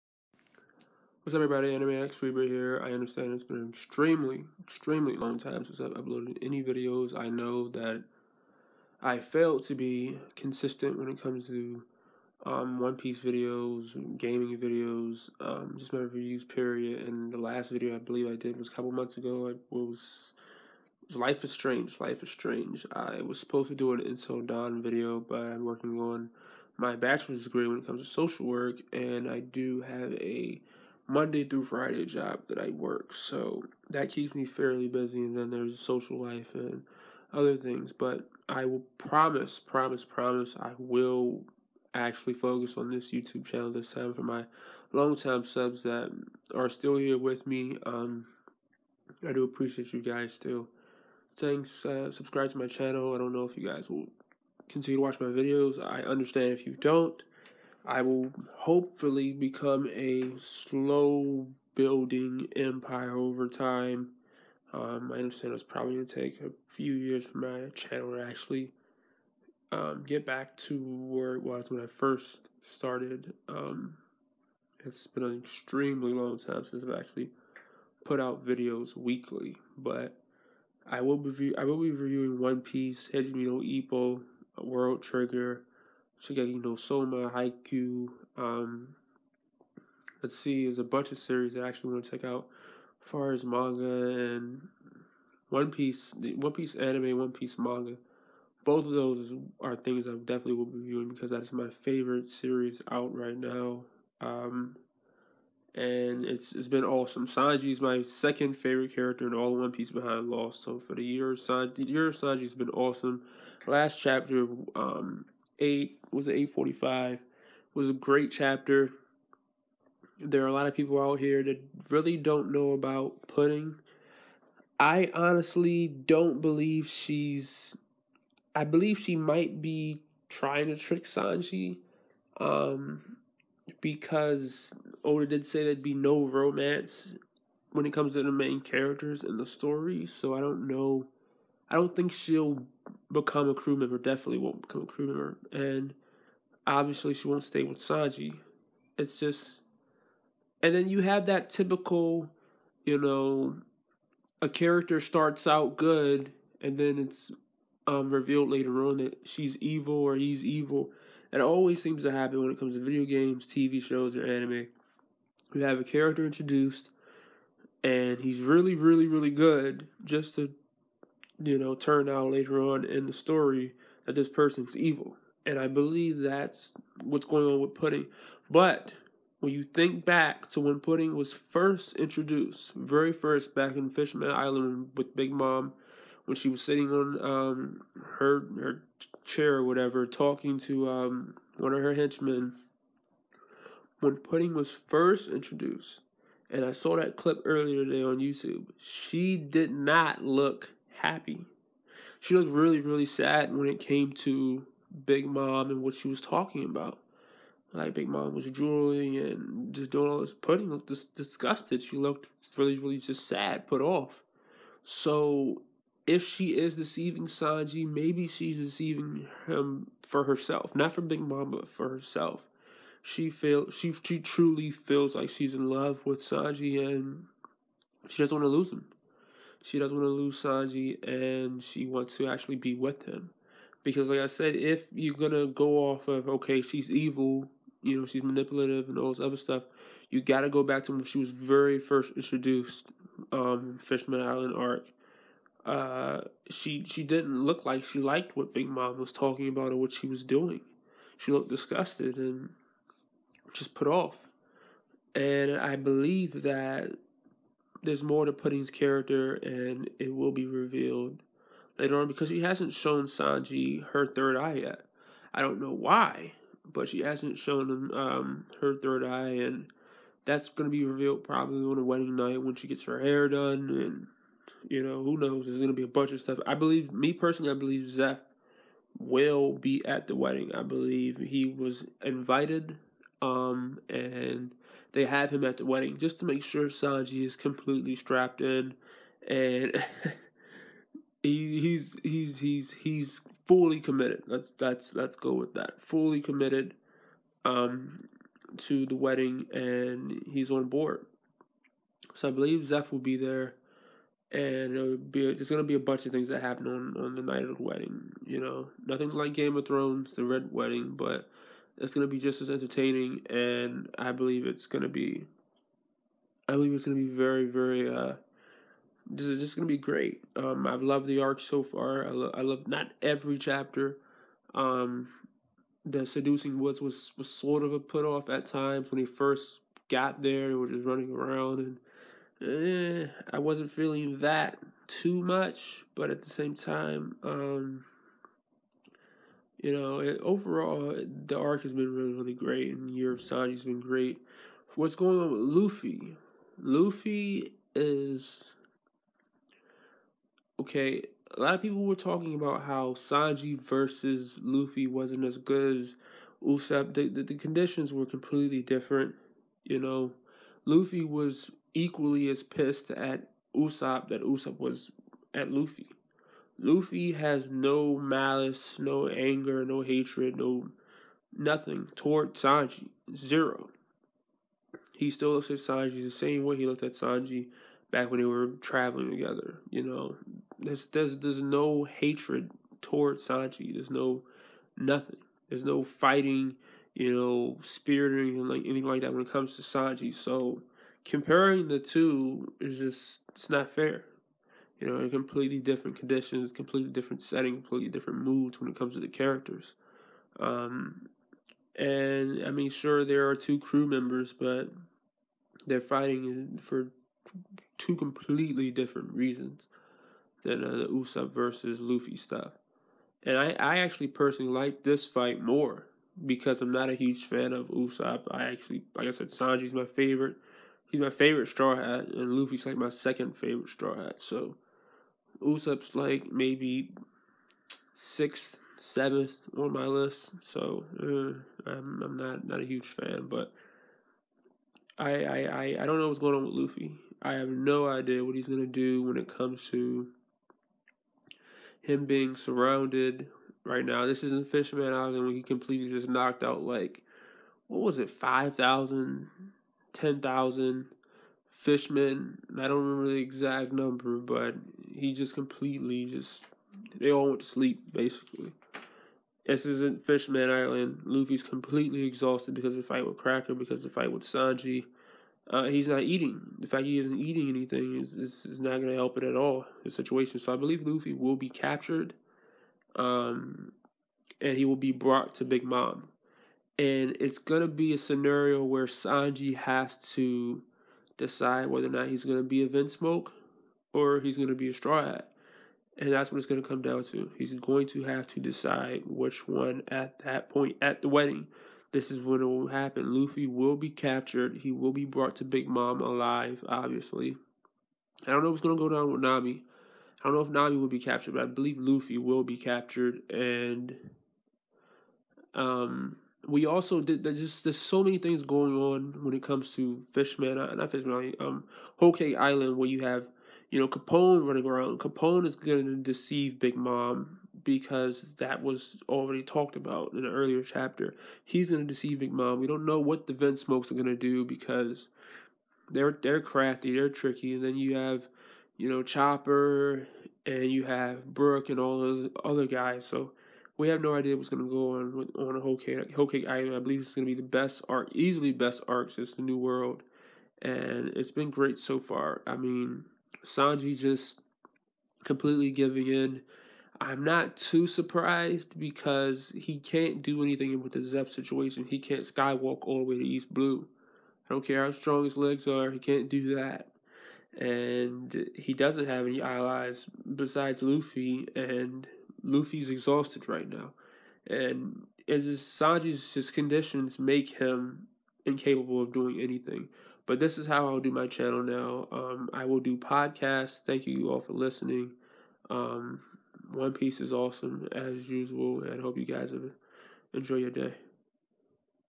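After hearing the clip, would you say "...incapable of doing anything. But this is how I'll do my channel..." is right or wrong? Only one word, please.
right.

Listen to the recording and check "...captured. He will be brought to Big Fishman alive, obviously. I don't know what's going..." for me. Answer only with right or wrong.
wrong.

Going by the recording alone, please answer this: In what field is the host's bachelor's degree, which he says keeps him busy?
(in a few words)
Social work.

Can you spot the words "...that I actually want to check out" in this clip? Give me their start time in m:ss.
1:31.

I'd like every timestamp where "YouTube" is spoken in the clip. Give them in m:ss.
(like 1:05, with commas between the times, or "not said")
0:43, 3:18.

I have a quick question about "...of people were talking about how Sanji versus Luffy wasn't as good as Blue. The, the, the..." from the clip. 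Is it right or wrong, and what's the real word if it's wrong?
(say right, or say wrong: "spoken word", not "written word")
wrong: "Usopp", not "Blue".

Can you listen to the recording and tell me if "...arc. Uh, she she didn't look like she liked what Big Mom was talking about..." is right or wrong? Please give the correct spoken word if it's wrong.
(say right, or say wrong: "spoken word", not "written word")
right.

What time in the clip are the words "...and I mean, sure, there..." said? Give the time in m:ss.
6:41.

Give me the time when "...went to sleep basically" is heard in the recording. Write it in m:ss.
7:37.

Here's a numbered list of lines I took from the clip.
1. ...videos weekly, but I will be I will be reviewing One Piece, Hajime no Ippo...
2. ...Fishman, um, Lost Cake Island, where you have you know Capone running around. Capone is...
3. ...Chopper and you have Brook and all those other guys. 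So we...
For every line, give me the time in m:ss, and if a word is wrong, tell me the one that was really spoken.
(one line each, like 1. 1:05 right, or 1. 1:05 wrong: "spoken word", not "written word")
1. 1:18 right
2. 8:30 wrong: "Whole", not "Lost"
3. 8:49 right.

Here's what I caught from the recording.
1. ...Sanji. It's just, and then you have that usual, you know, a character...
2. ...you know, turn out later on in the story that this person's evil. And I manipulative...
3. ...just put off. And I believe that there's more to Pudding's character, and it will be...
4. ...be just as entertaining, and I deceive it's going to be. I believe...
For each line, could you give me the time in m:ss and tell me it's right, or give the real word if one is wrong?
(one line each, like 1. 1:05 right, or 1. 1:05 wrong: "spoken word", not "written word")
1. 2:27 wrong: "typical", not "usual"
2. 2:51 wrong: "believe", not "manipulative"
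3. 4:13 right
4. 5:12 wrong: "believe", not "deceive".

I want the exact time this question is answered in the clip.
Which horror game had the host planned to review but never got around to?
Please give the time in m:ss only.
0:24.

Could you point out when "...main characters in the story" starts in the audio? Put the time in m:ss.
2:18.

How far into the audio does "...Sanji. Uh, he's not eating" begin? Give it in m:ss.
7:44.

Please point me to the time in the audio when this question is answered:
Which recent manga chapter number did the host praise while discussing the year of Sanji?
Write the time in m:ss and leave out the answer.
1:56.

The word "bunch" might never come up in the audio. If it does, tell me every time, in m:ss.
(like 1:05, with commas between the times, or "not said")
1:30, 4:35, 5:05.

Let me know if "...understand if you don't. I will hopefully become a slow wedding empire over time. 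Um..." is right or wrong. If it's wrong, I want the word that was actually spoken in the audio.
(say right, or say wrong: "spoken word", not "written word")
wrong: "building", not "wedding".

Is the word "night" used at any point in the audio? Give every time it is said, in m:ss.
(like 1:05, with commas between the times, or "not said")
4:32, 5:07.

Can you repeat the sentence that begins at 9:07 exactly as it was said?
I'm not too surprised because he can't do anything with the Zeff situation.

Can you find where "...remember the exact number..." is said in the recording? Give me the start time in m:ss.
7:32.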